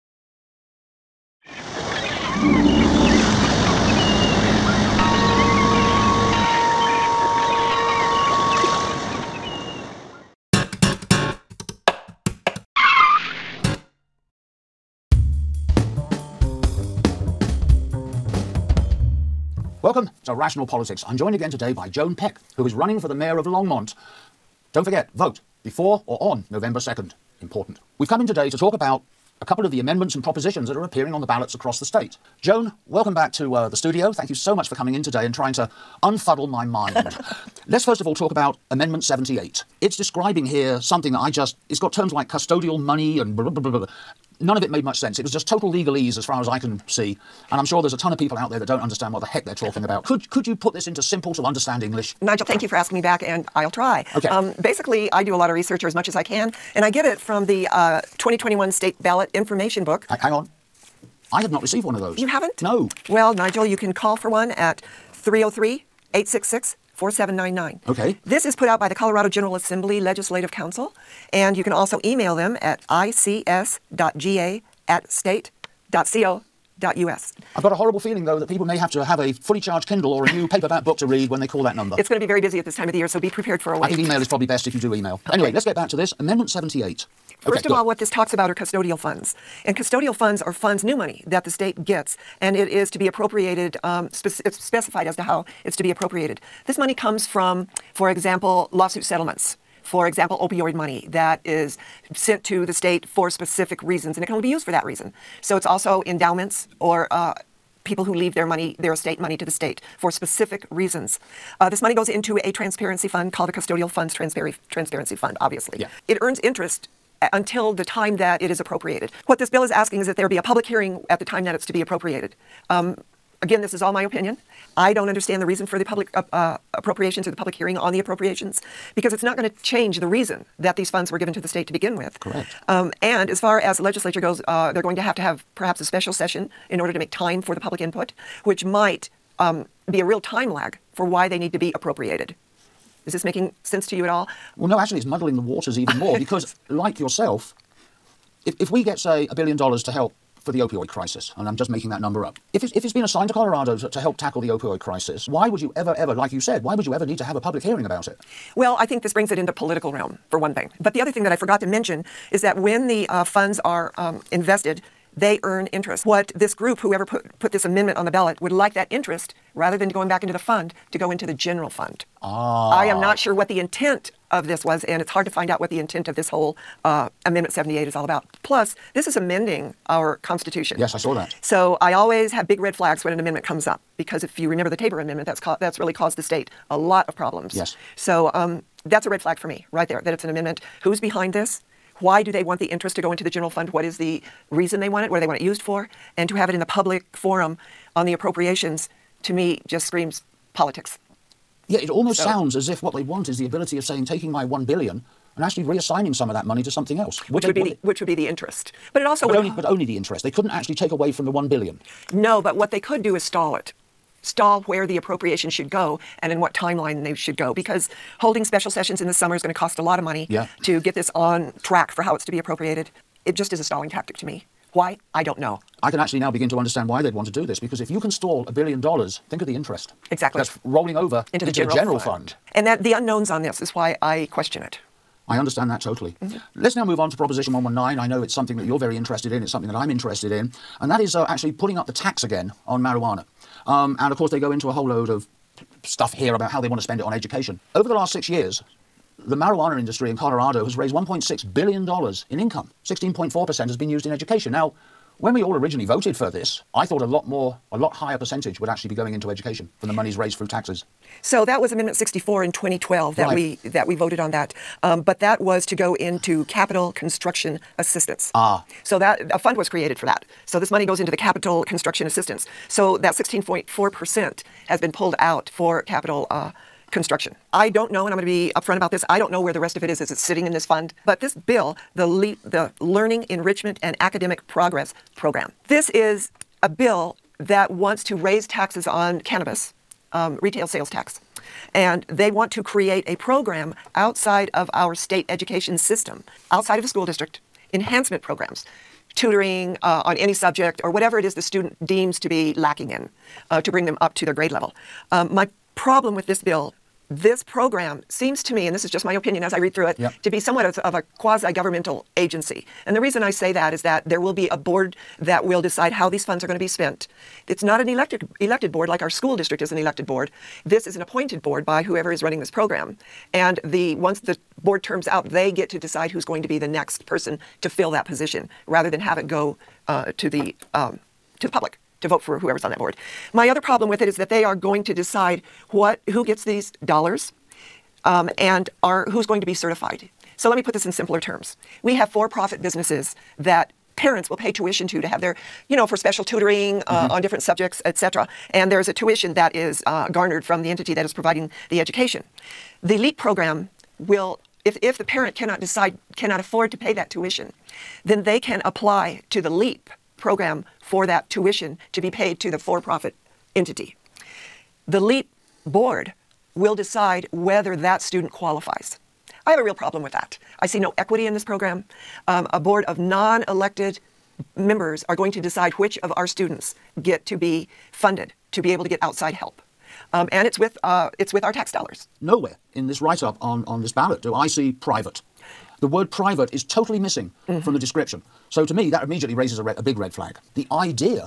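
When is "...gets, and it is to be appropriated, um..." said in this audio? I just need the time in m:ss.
1:31.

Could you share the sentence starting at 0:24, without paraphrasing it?
Don't forget, vote before or on November 2nd.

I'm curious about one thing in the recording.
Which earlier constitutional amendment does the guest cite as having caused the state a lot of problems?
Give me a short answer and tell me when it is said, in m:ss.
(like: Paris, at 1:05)
Tabor Amendment, at 3:04.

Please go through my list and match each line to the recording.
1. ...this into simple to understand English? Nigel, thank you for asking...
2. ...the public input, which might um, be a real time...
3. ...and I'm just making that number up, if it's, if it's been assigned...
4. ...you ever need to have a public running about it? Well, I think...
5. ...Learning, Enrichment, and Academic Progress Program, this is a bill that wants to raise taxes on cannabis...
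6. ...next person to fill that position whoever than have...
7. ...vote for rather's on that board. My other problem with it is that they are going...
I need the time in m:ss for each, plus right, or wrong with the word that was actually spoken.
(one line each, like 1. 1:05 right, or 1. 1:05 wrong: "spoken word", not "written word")
1. 0:50 right
2. 2:17 right
3. 2:31 right
4. 2:36 wrong: "hearing", not "running"
5. 4:42 right
6. 5:26 wrong: "rather", not "whoever"
7. 5:32 wrong: "whoever", not "rather".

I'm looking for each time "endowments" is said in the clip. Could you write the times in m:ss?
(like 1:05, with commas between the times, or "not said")
1:46.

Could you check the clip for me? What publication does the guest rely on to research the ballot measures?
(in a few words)
2021 state ballot information book.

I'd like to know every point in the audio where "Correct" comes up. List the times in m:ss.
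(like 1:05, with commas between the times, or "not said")
2:12.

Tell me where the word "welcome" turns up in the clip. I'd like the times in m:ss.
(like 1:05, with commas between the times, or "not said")
0:19, 0:32.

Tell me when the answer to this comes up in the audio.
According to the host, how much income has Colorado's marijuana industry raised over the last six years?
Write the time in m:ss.
4:10.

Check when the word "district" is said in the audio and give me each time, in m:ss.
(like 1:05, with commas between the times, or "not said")
4:57, 5:19.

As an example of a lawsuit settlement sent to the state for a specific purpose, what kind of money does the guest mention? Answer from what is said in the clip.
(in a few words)
opioid money.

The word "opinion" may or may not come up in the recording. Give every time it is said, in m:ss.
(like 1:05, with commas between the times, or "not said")
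2:04, 5:09.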